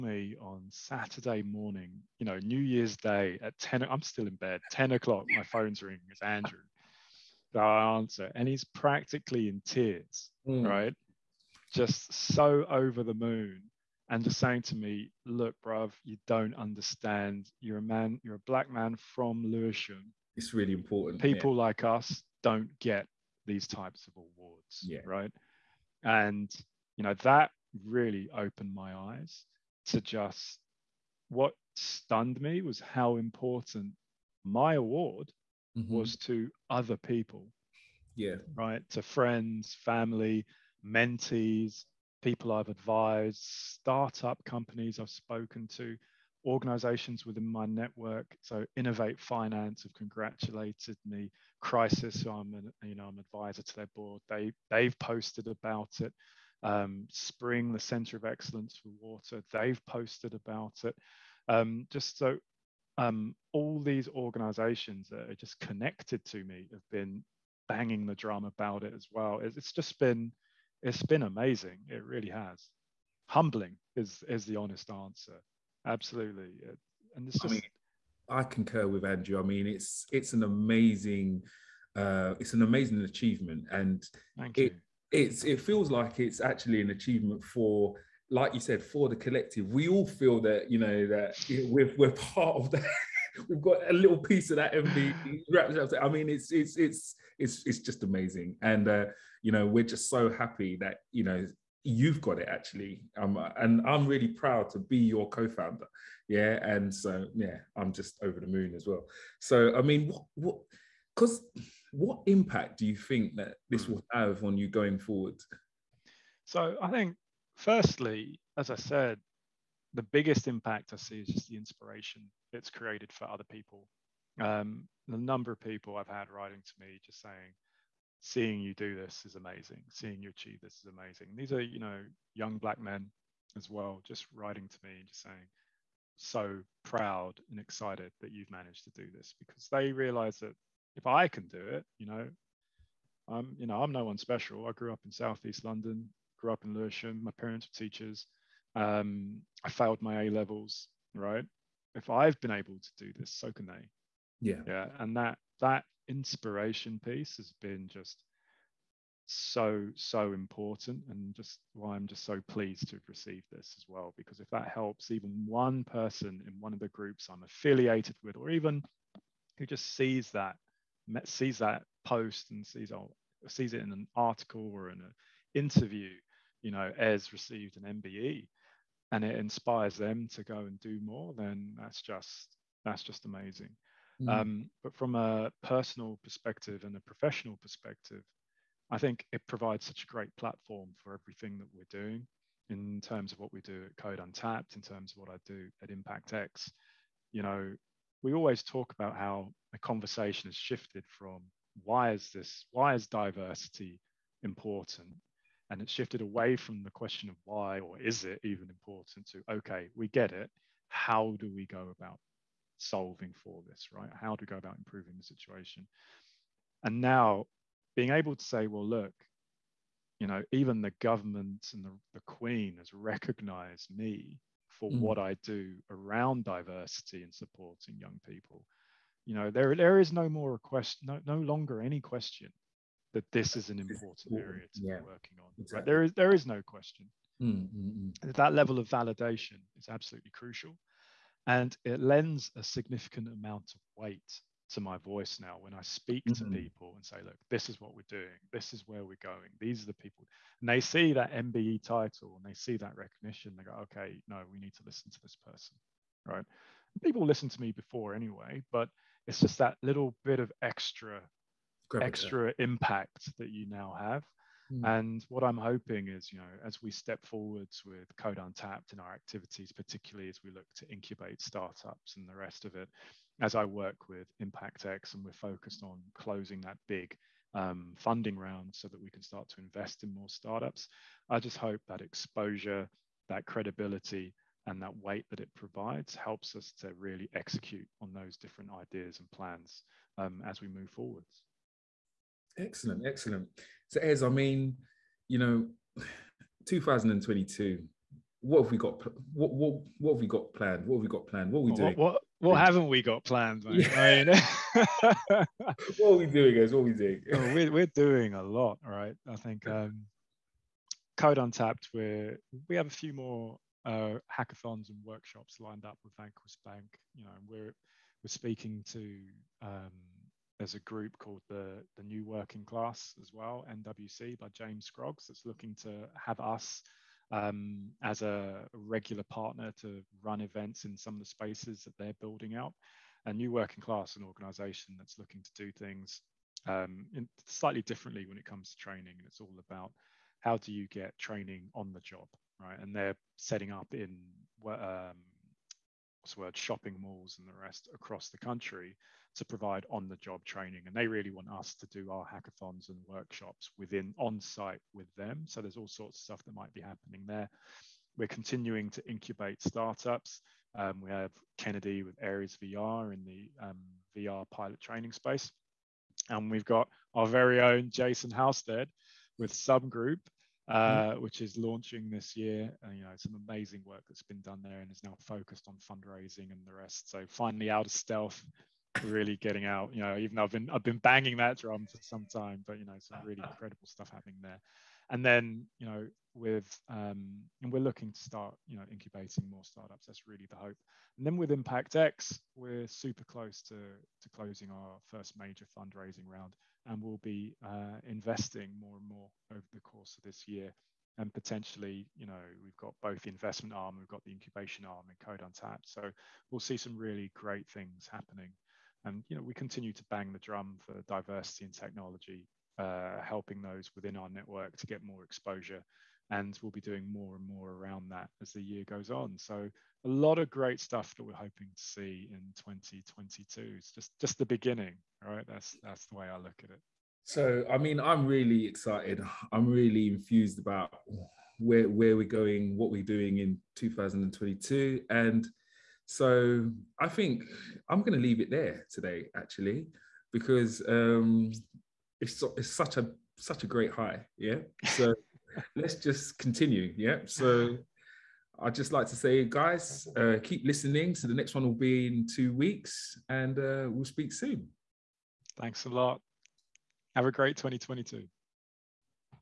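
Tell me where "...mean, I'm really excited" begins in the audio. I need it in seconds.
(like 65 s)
427 s.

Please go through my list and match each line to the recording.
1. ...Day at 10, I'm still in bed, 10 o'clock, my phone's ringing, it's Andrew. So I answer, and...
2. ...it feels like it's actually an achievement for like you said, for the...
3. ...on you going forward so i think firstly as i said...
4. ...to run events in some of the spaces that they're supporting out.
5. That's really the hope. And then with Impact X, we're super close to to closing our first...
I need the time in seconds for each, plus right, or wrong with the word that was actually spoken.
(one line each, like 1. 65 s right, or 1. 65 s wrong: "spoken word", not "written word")
1. 2 s right
2. 85 s right
3. 114 s right
4. 329 s wrong: "building", not "supporting"
5. 390 s right.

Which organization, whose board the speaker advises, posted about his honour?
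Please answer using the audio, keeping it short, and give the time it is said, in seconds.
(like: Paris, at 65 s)
Crisis, at 51 s.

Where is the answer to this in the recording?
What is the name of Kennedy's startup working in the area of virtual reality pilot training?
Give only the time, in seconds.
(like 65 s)
362 s.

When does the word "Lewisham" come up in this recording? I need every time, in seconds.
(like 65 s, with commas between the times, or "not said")
19 s, 146 s.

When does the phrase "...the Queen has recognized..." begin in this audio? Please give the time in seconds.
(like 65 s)
222 s.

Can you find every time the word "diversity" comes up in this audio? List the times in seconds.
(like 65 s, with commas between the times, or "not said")
203 s, 226 s, 411 s.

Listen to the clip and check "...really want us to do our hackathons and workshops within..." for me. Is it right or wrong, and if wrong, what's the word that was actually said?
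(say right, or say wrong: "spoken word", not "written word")
right.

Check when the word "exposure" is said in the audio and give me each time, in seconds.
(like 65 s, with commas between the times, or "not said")
282 s, 415 s.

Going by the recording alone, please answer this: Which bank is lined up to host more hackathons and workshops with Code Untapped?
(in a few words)
Vanquis Bank.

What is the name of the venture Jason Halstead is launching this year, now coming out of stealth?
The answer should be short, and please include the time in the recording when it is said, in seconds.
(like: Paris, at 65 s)
Subgroup, at 369 s.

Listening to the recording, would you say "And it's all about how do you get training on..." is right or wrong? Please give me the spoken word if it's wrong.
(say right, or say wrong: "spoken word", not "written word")
right.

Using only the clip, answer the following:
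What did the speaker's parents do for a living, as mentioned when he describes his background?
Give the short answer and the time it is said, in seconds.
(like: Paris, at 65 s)
Teachers, at 147 s.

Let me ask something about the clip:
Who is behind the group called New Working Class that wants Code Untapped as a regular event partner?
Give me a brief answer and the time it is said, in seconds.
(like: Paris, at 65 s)
James Scroggs, at 324 s.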